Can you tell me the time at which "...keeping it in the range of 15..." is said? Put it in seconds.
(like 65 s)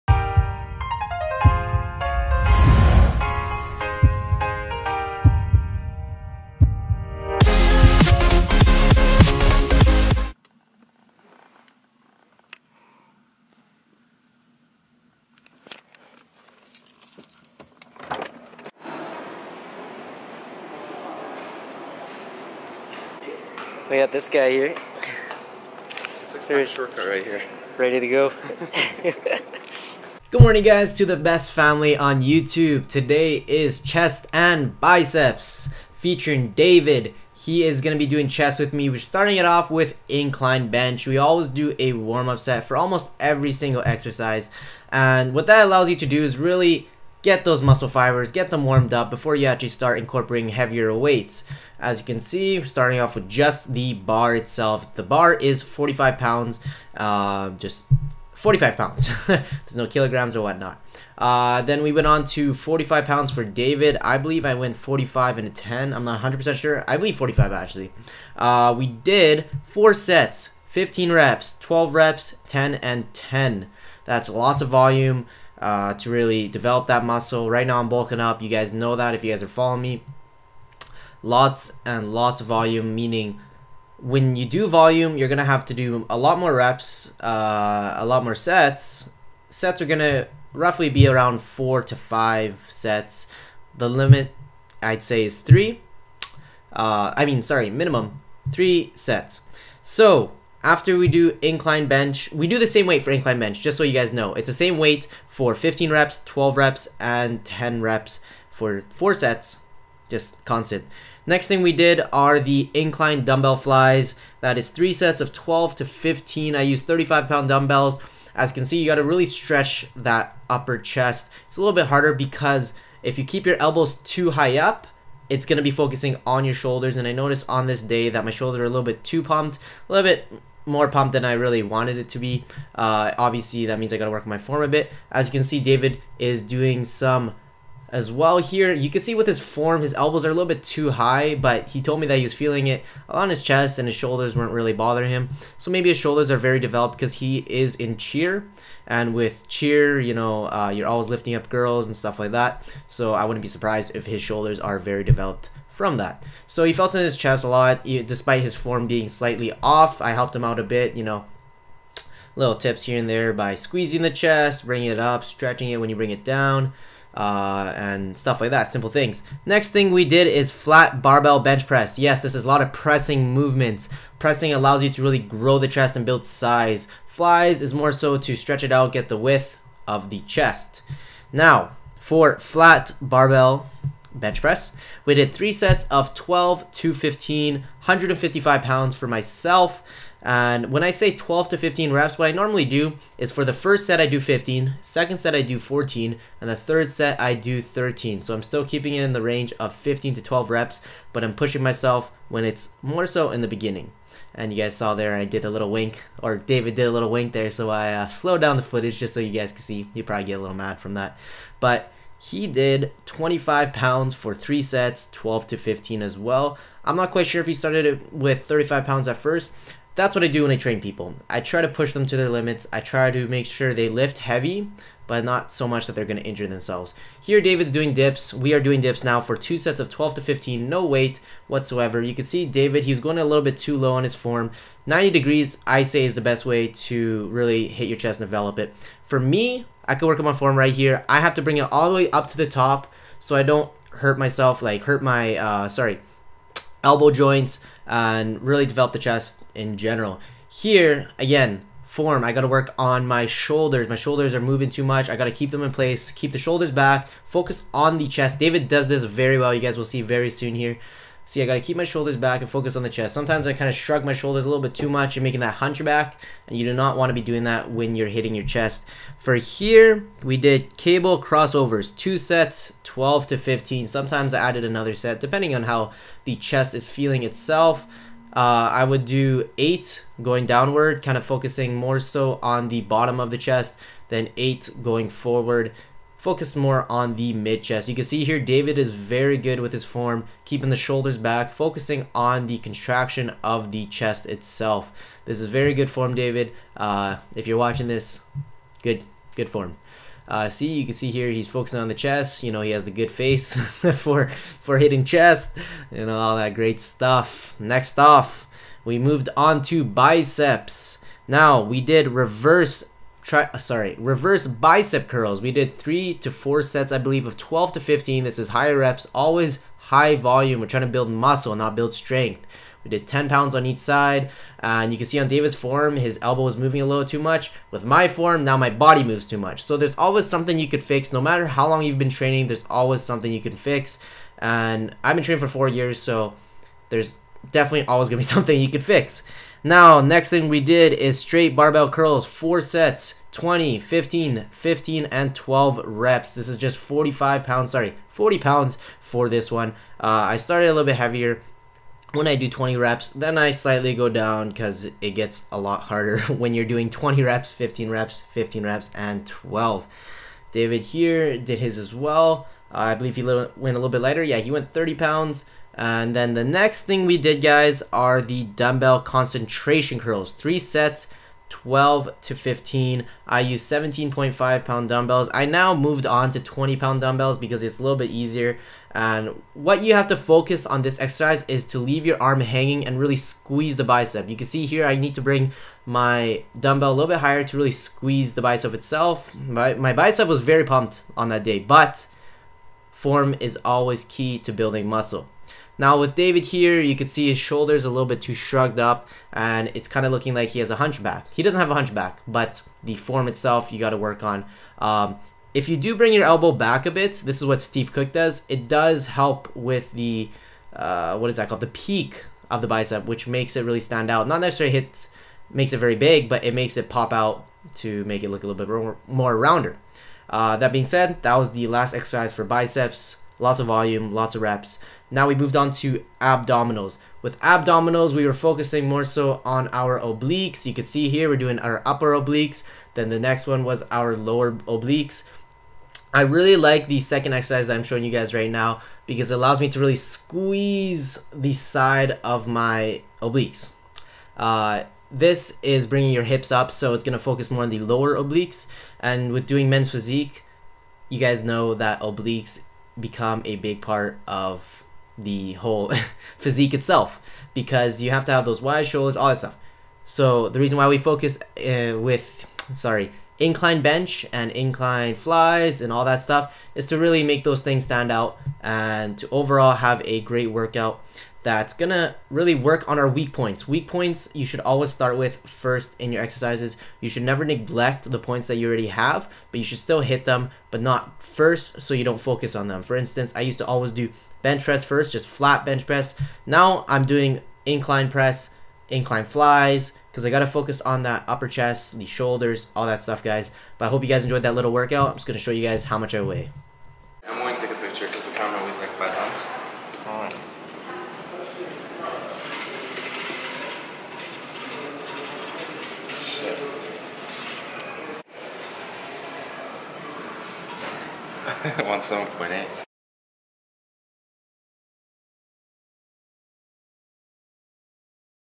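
198 s.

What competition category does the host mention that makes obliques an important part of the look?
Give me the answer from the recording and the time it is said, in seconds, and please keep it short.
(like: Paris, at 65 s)
Men's physique, at 449 s.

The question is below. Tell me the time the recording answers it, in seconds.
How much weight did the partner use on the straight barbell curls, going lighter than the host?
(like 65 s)
364 s.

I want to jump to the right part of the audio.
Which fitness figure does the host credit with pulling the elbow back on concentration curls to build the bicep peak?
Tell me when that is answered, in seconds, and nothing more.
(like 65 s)
407 s.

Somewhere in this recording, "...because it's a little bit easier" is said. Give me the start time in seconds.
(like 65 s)
377 s.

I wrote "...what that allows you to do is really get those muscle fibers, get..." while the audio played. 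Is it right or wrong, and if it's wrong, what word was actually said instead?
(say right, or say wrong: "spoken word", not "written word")
right.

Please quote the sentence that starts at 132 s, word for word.
Uh, obviously, that means I got to work on my form a bit.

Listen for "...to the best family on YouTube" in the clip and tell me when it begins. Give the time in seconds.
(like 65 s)
30 s.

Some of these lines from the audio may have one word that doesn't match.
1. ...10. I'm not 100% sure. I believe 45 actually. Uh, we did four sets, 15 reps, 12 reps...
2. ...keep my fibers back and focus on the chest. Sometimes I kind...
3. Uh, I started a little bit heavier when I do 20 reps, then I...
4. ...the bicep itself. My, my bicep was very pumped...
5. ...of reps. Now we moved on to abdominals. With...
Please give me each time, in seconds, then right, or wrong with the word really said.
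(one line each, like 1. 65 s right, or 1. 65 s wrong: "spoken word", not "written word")
1. 65 s right
2. 261 s wrong: "shoulders", not "fibers"
3. 349 s right
4. 388 s right
5. 424 s right.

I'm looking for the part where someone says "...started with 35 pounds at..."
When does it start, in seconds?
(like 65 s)
217 s.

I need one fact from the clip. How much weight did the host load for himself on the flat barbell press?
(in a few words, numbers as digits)
155 pounds.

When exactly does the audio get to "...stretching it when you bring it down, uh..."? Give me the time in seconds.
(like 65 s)
165 s.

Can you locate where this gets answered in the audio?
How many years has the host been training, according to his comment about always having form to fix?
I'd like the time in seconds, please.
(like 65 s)
335 s.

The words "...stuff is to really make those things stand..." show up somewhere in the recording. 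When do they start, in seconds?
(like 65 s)
466 s.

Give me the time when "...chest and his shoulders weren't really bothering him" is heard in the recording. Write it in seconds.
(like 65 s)
143 s.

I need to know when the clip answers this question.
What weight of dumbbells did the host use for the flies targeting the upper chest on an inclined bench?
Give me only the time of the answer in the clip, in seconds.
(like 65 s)
116 s.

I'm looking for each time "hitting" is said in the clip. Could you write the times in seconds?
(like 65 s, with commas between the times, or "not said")
268 s, 304 s.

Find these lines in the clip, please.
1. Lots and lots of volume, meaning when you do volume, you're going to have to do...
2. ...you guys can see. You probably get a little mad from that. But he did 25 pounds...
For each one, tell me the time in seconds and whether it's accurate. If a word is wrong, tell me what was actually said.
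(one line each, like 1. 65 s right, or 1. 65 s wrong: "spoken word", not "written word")
1. 81 s right
2. 209 s right.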